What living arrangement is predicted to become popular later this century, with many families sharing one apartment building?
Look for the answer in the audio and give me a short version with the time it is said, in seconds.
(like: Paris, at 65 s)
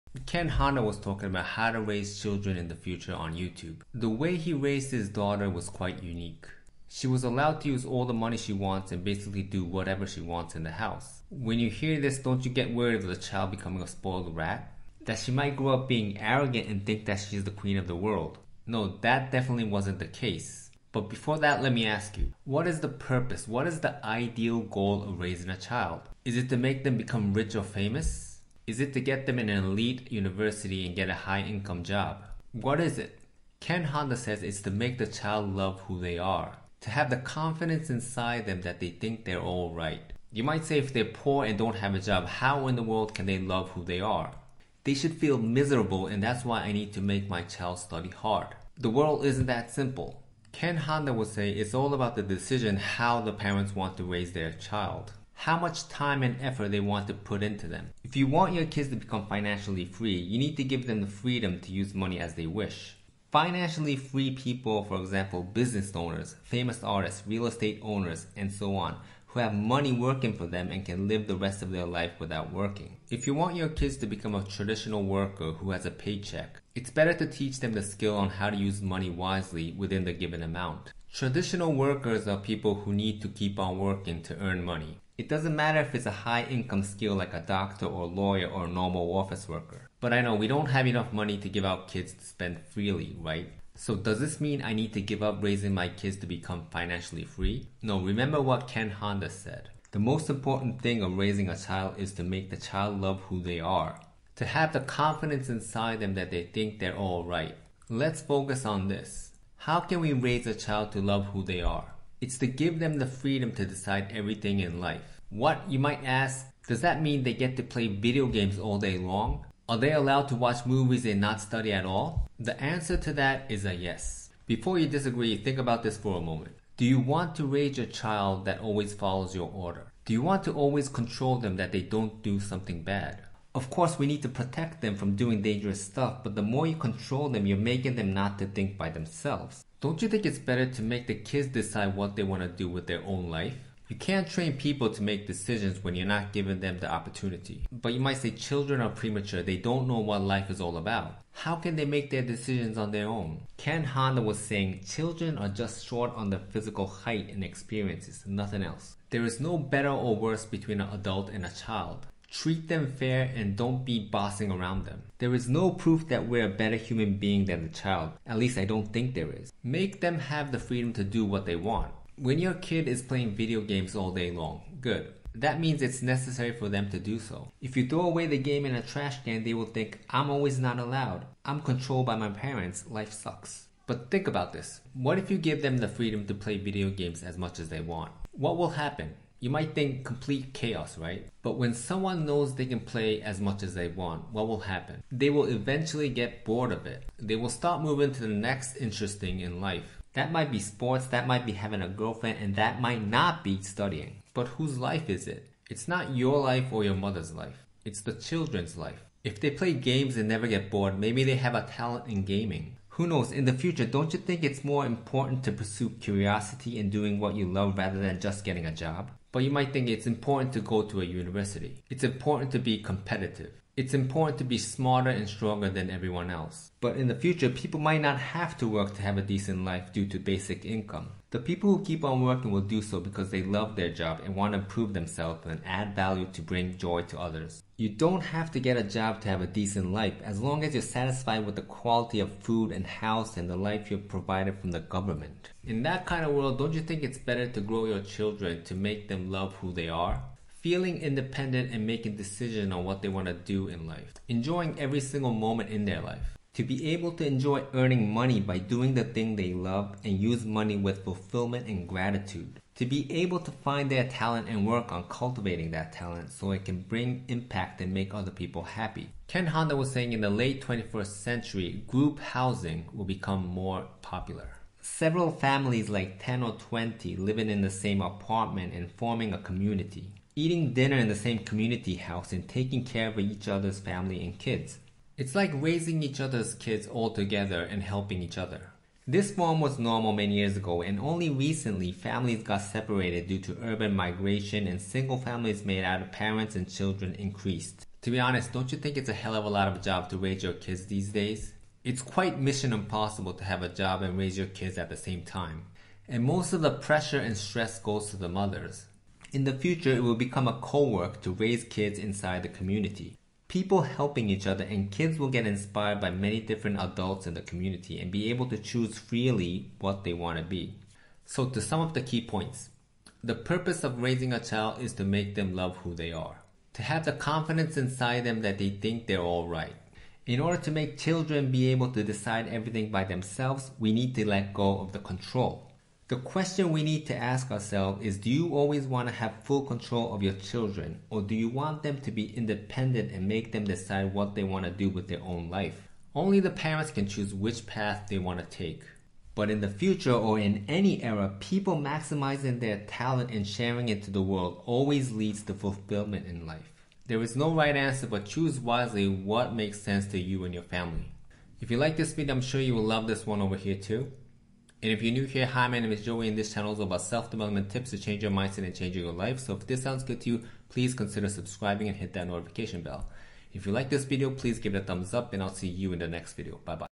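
group housing, at 271 s.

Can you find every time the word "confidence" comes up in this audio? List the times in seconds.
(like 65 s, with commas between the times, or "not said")
37 s, 104 s, 327 s.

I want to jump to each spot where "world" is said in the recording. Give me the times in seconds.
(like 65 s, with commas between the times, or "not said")
17 s, 42 s, 48 s, 246 s, 354 s.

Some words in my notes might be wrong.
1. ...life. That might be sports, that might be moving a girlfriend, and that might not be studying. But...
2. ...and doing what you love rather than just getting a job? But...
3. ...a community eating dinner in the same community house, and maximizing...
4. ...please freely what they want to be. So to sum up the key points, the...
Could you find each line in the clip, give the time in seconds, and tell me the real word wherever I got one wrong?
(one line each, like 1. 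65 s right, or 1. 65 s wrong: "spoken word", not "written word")
1. 199 s wrong: "having", not "moving"
2. 216 s right
3. 279 s wrong: "taking", not "maximizing"
4. 318 s wrong: "choose", not "please".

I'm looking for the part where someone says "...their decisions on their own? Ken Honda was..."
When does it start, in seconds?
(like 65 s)
152 s.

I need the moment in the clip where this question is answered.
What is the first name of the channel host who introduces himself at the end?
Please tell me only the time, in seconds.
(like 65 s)
366 s.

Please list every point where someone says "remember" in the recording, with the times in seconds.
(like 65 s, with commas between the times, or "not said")
98 s.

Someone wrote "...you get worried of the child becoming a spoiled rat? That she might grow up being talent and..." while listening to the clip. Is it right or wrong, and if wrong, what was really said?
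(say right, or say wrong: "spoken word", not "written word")
wrong: "arrogant", not "talent".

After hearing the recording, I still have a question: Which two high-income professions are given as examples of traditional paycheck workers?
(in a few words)
doctor or lawyer.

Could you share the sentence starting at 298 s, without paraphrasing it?
To be honest, don't you think it's a hell of a lot of a job to raise your kids these days?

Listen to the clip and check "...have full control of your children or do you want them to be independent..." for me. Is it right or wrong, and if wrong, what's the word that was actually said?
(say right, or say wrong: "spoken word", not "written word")
right.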